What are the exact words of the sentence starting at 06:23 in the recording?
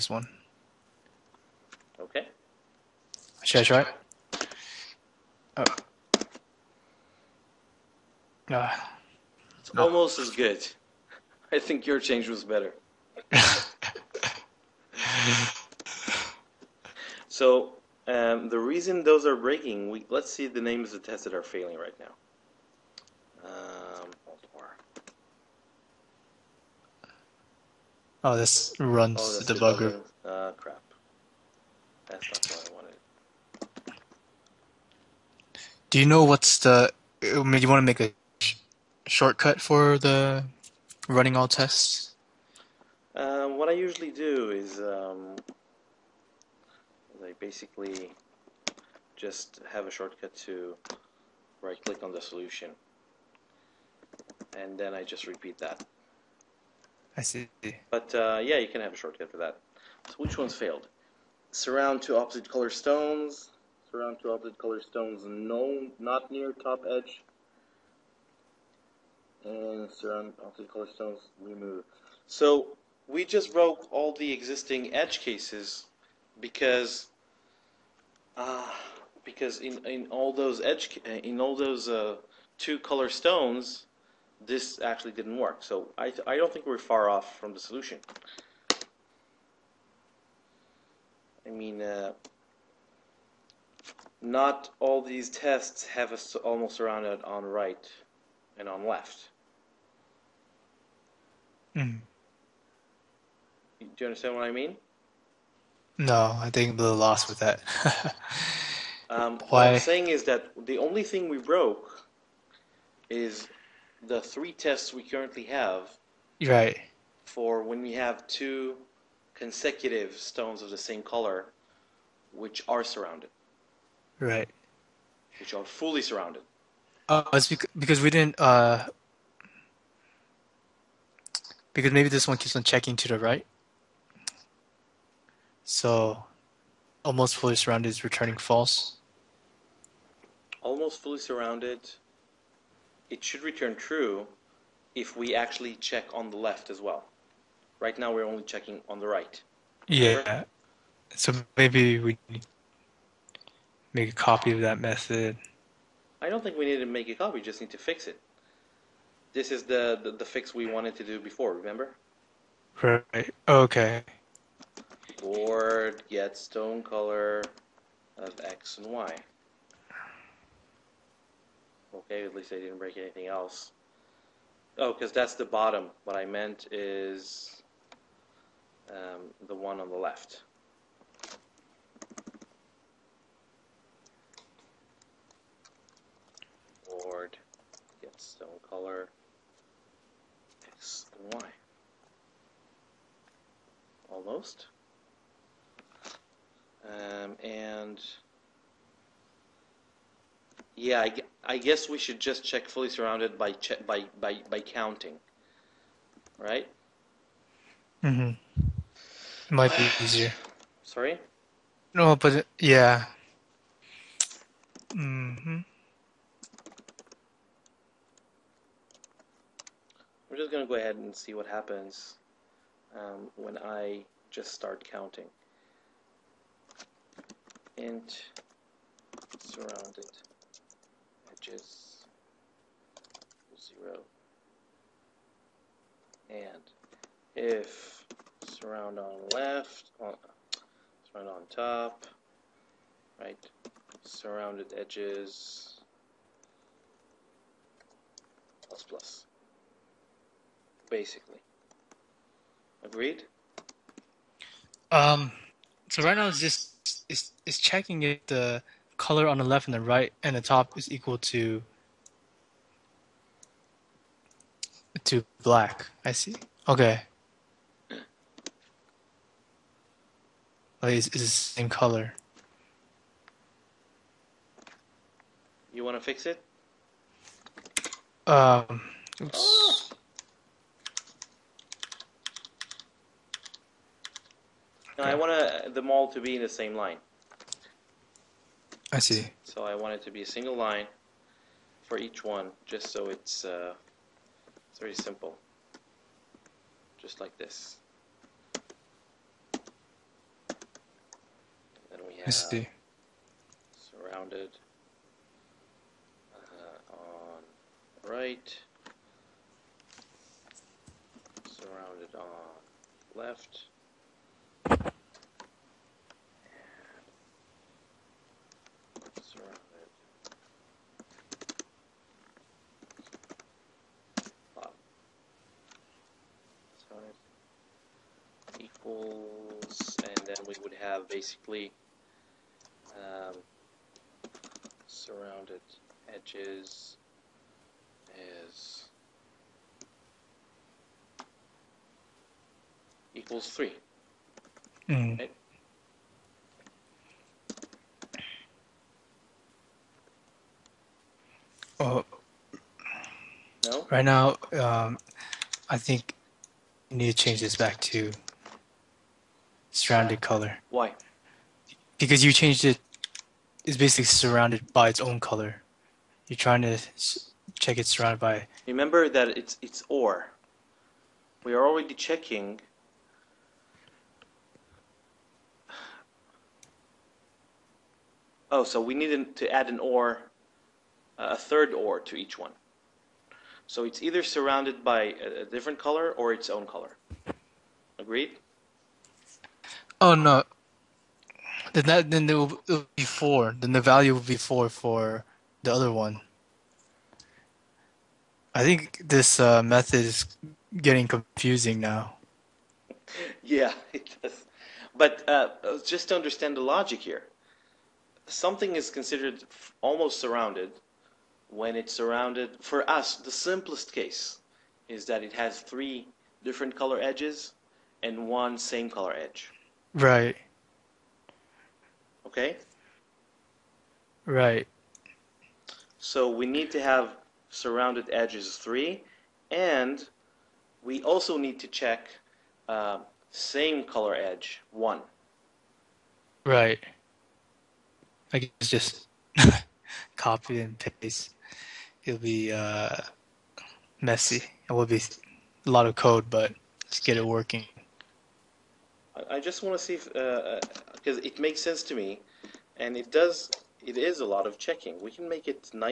So it's either surrounded by a different color or its own color.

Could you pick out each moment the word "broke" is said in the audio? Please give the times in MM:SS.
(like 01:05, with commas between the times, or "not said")
01:13, 01:51.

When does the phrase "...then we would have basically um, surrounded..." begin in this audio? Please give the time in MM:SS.
05:30.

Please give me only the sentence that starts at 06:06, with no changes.
You're trying to check it's surrounded by.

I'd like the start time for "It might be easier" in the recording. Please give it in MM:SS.
03:29.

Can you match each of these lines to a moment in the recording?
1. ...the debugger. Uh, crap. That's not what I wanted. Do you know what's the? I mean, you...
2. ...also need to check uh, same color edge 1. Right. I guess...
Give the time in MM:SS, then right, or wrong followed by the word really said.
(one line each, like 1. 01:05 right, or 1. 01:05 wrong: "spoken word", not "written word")
1. 00:29 right
2. 07:11 right.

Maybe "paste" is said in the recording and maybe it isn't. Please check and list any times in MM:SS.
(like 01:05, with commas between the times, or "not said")
07:21.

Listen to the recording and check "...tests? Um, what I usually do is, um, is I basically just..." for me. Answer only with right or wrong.
right.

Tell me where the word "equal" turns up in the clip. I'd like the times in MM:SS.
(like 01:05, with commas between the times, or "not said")
04:20, 05:43.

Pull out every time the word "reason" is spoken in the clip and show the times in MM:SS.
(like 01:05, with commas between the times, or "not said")
00:18.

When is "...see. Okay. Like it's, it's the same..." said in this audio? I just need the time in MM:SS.
04:26.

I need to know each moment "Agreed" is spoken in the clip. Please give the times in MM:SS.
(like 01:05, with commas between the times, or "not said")
04:12, 06:27.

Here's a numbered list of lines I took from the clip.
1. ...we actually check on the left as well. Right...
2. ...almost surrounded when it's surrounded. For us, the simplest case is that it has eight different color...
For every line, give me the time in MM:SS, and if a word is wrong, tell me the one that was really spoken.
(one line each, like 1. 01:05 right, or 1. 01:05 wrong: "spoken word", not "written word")
1. 02:25 right
2. 06:49 wrong: "three", not "eight".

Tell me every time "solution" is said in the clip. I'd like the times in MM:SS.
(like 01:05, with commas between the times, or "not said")
00:52, 01:27.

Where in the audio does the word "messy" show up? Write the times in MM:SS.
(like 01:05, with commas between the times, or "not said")
07:24.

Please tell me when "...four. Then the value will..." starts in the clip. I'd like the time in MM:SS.
06:33.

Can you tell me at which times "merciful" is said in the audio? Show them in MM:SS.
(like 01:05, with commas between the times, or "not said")
not said.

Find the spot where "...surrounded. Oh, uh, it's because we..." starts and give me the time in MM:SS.
02:06.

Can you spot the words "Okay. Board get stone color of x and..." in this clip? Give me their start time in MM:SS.
02:43.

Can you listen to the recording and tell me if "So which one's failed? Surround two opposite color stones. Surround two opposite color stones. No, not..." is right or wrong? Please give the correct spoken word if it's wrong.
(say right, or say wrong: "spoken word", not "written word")
right.